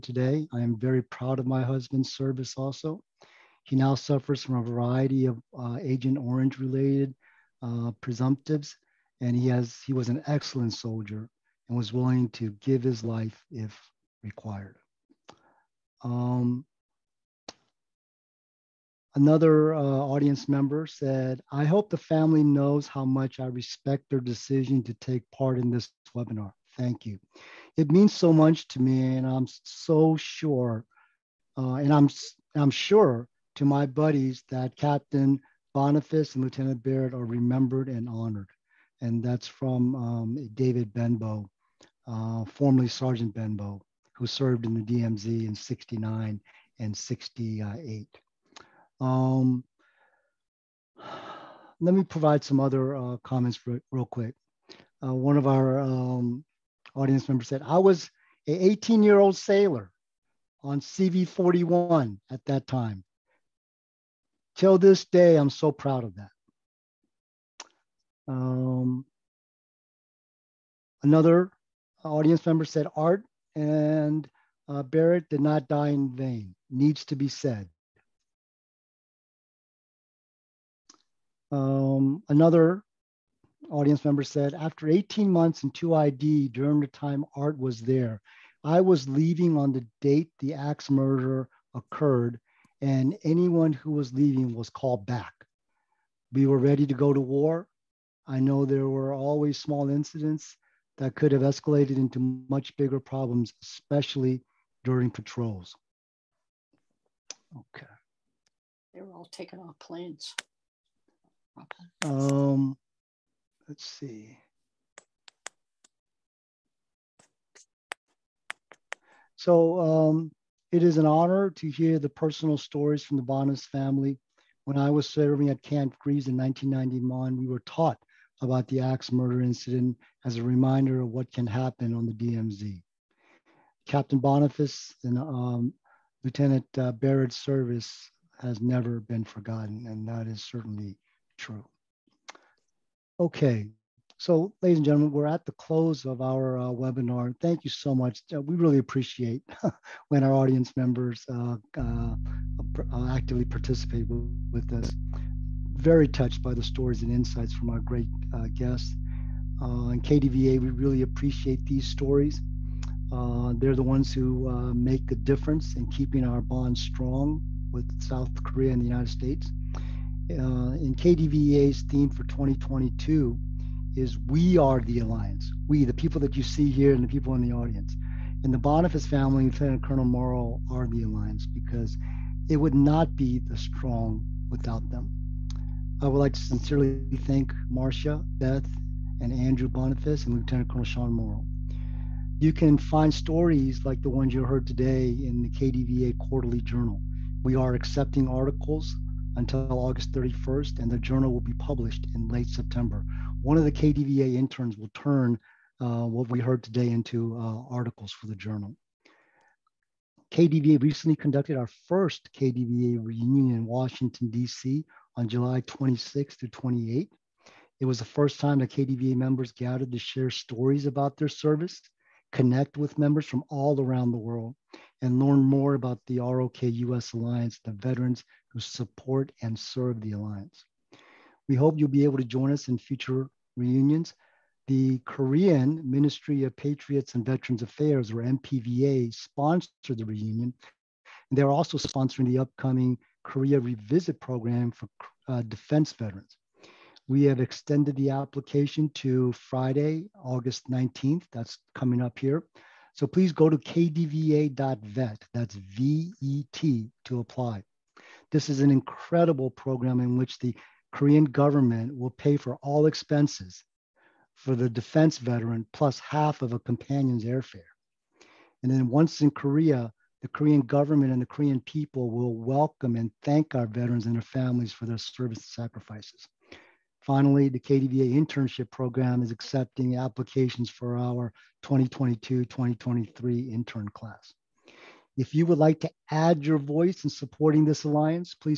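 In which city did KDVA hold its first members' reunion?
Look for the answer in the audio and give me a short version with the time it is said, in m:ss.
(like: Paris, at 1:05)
Washington, D.C., at 3:33.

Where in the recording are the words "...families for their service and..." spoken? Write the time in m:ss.
4:34.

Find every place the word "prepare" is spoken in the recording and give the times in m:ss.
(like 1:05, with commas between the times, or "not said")
not said.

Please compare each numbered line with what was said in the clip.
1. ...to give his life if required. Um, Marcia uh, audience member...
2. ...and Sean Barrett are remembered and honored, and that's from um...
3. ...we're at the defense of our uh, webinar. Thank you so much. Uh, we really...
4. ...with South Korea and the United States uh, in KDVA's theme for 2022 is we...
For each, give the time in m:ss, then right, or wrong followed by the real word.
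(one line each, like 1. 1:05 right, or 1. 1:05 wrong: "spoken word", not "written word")
1. 0:12 wrong: "Another", not "Marcia"
2. 0:36 wrong: "Lieutenant", not "Sean"
3. 2:25 wrong: "close", not "defense"
4. 2:47 right.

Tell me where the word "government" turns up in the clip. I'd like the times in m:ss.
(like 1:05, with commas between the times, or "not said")
4:21, 4:30.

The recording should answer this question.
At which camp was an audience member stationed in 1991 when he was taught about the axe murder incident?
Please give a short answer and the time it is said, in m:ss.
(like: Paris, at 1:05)
Camp Greaves, at 2:05.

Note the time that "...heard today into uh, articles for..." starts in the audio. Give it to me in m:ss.
3:26.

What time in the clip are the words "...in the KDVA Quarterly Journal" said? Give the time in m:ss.
3:15.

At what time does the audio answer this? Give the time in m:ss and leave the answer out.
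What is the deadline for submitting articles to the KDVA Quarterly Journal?
3:19.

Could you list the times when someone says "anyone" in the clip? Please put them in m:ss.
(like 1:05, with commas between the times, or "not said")
1:33.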